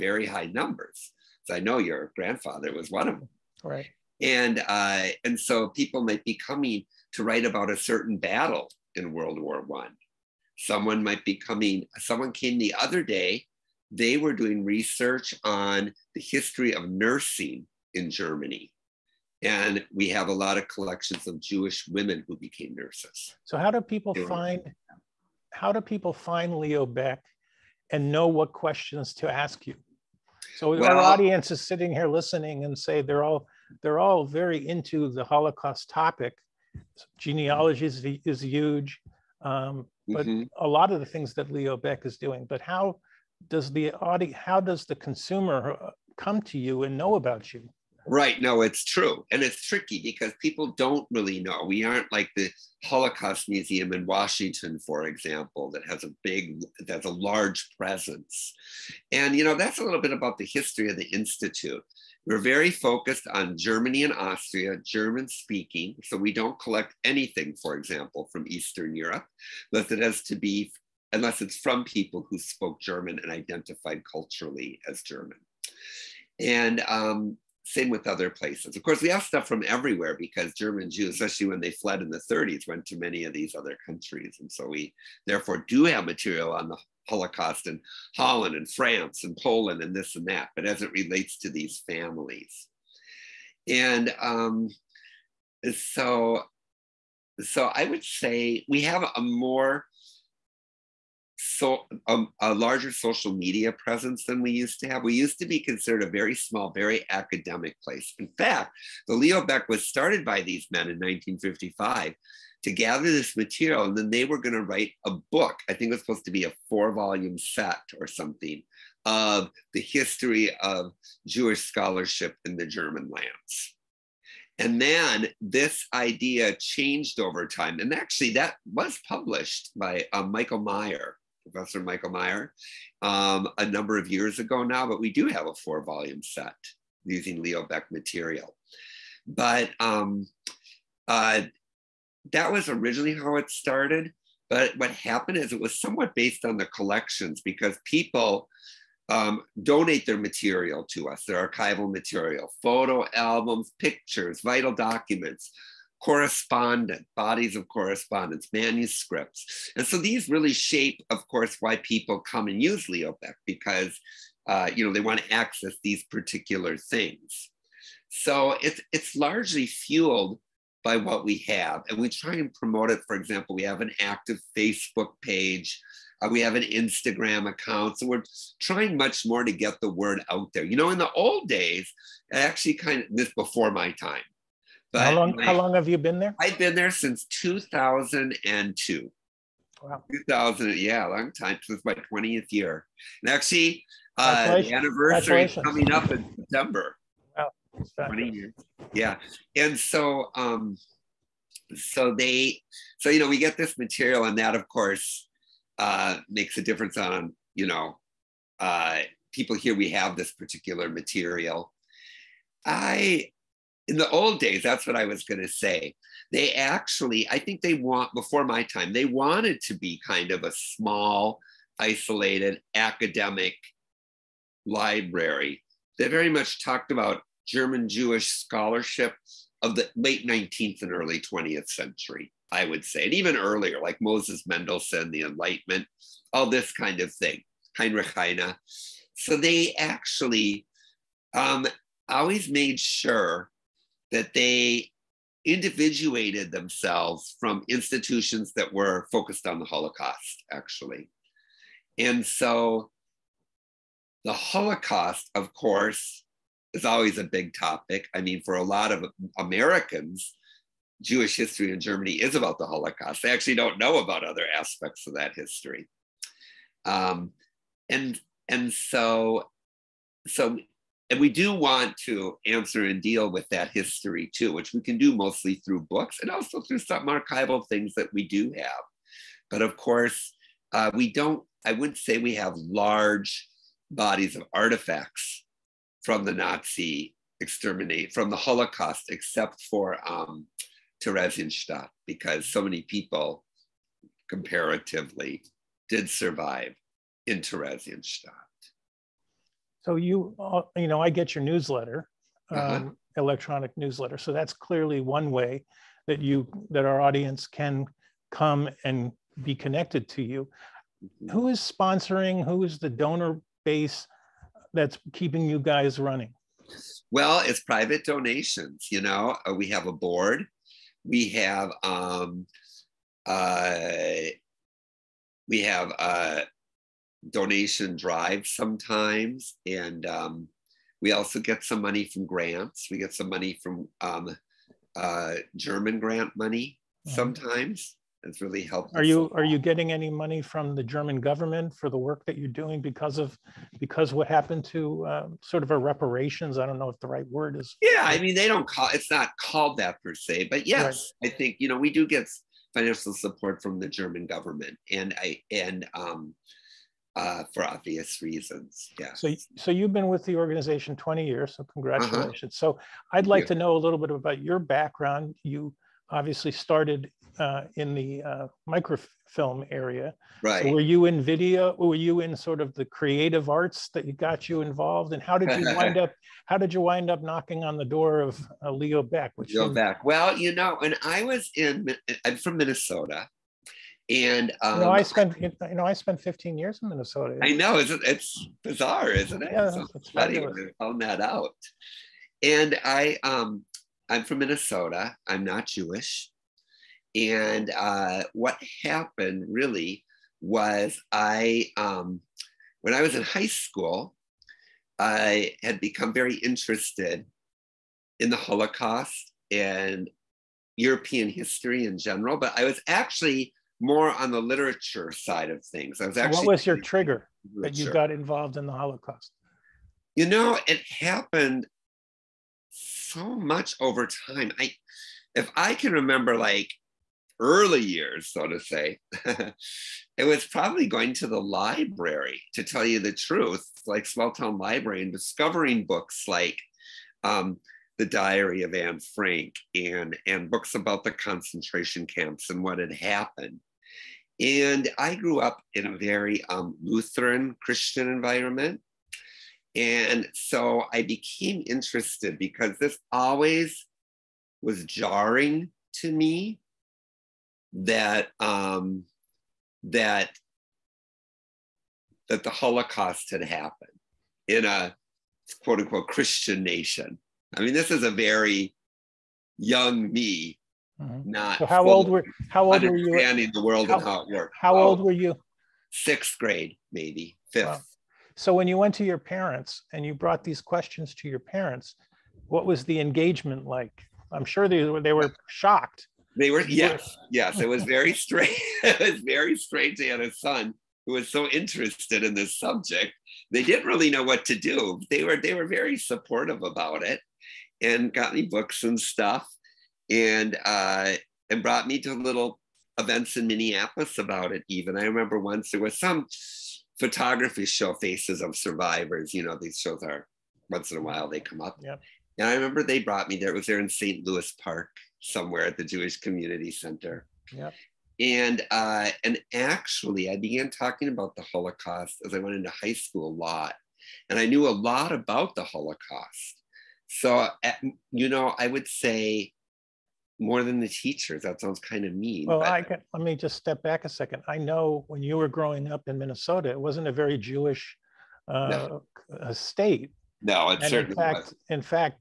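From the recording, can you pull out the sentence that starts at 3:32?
I, in the old days, that's what I was going to say.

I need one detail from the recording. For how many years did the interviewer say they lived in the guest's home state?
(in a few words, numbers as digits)
15.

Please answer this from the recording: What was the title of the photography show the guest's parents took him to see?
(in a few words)
Faces of Survivors.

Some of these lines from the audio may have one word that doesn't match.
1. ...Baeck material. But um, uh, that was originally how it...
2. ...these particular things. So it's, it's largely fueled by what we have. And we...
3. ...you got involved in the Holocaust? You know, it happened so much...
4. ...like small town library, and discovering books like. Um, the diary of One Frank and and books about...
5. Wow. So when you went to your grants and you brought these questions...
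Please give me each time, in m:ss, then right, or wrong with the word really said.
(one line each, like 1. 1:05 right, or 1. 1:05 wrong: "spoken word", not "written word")
1. 2:17 right
2. 2:45 right
3. 6:57 right
4. 7:13 wrong: "Anne", not "One"
5. 7:57 wrong: "parents", not "grants".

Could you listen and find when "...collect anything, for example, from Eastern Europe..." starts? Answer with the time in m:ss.
1:06.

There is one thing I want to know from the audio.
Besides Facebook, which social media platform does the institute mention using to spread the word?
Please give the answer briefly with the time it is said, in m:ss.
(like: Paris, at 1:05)
Instagram, at 2:56.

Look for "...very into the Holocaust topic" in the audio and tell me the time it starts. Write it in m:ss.
0:34.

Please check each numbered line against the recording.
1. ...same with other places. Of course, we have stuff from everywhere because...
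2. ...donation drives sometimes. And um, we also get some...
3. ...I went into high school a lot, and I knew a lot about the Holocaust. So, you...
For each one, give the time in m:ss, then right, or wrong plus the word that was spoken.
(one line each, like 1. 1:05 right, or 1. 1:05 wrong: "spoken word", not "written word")
1. 1:17 right
2. 5:27 right
3. 8:42 right.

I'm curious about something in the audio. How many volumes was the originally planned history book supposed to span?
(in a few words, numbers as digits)
4.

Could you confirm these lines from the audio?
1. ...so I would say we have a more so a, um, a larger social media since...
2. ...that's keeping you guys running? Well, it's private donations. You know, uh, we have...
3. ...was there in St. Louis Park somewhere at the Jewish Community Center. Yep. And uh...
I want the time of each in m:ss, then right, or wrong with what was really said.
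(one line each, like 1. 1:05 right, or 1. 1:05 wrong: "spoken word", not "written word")
1. 1:37 wrong: "presence", not "since"
2. 5:14 right
3. 8:33 right.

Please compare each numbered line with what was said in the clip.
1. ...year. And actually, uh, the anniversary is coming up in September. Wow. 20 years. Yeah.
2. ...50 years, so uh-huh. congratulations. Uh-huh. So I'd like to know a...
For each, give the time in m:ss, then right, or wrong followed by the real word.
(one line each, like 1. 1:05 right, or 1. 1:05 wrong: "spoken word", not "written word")
1. 3:12 right
2. 6:00 wrong: "20", not "50".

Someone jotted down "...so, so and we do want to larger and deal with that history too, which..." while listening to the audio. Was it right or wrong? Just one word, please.
wrong.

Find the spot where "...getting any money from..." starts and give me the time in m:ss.
5:39.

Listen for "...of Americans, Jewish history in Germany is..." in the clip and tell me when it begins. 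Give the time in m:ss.
4:18.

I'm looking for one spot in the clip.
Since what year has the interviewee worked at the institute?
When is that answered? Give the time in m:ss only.
3:07.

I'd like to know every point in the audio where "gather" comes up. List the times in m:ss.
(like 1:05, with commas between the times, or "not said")
1:52.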